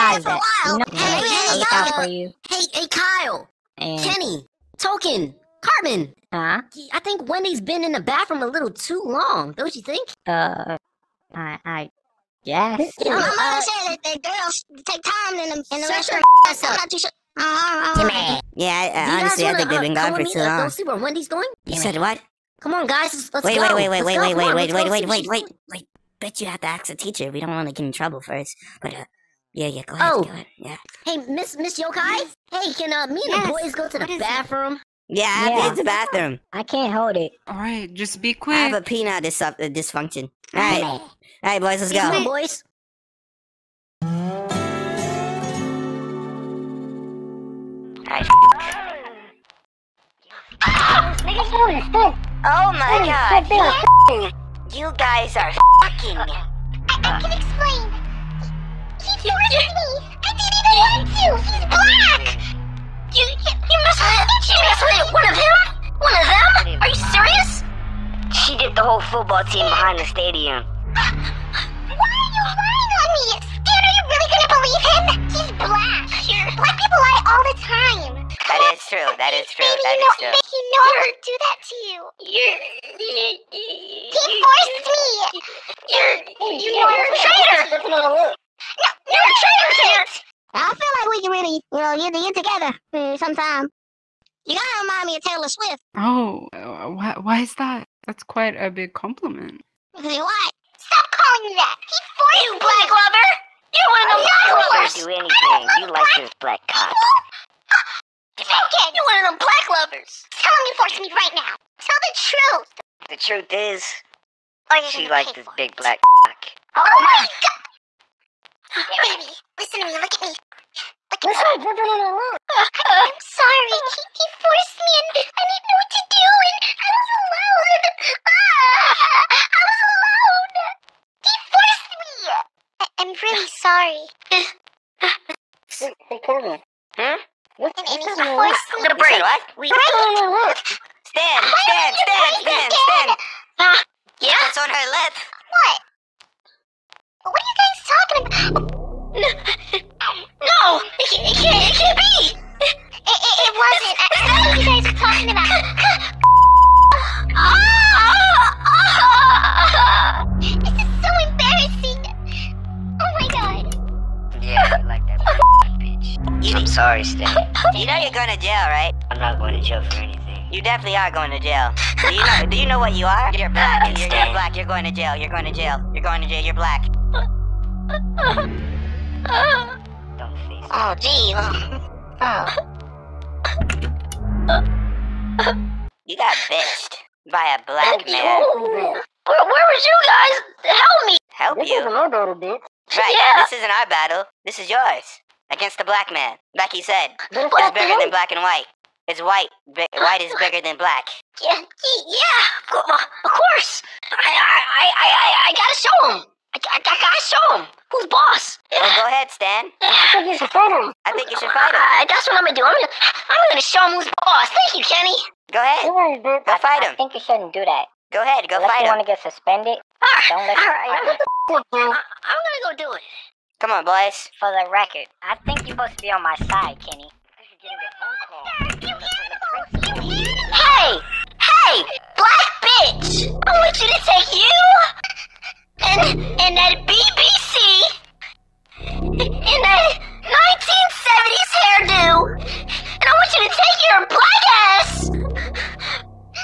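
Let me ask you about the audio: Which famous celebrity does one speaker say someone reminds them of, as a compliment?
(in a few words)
Taylor Swift.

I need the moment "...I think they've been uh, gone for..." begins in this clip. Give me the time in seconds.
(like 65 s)
19 s.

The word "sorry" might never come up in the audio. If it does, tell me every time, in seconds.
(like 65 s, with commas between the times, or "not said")
121 s, 134 s.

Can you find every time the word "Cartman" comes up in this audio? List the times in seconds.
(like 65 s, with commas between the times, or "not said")
5 s, 136 s.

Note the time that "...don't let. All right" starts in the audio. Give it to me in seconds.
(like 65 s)
220 s.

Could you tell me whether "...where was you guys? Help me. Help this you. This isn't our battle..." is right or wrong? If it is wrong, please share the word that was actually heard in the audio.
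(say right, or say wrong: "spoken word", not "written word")
right.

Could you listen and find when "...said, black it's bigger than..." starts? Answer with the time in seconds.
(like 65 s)
196 s.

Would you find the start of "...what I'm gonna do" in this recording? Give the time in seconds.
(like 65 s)
212 s.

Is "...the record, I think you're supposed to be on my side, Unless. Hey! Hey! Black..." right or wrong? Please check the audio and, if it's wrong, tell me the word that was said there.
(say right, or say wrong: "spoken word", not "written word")
wrong: "Kenny", not "Unless".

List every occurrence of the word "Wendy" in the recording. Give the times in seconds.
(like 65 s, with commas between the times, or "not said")
7 s, 20 s.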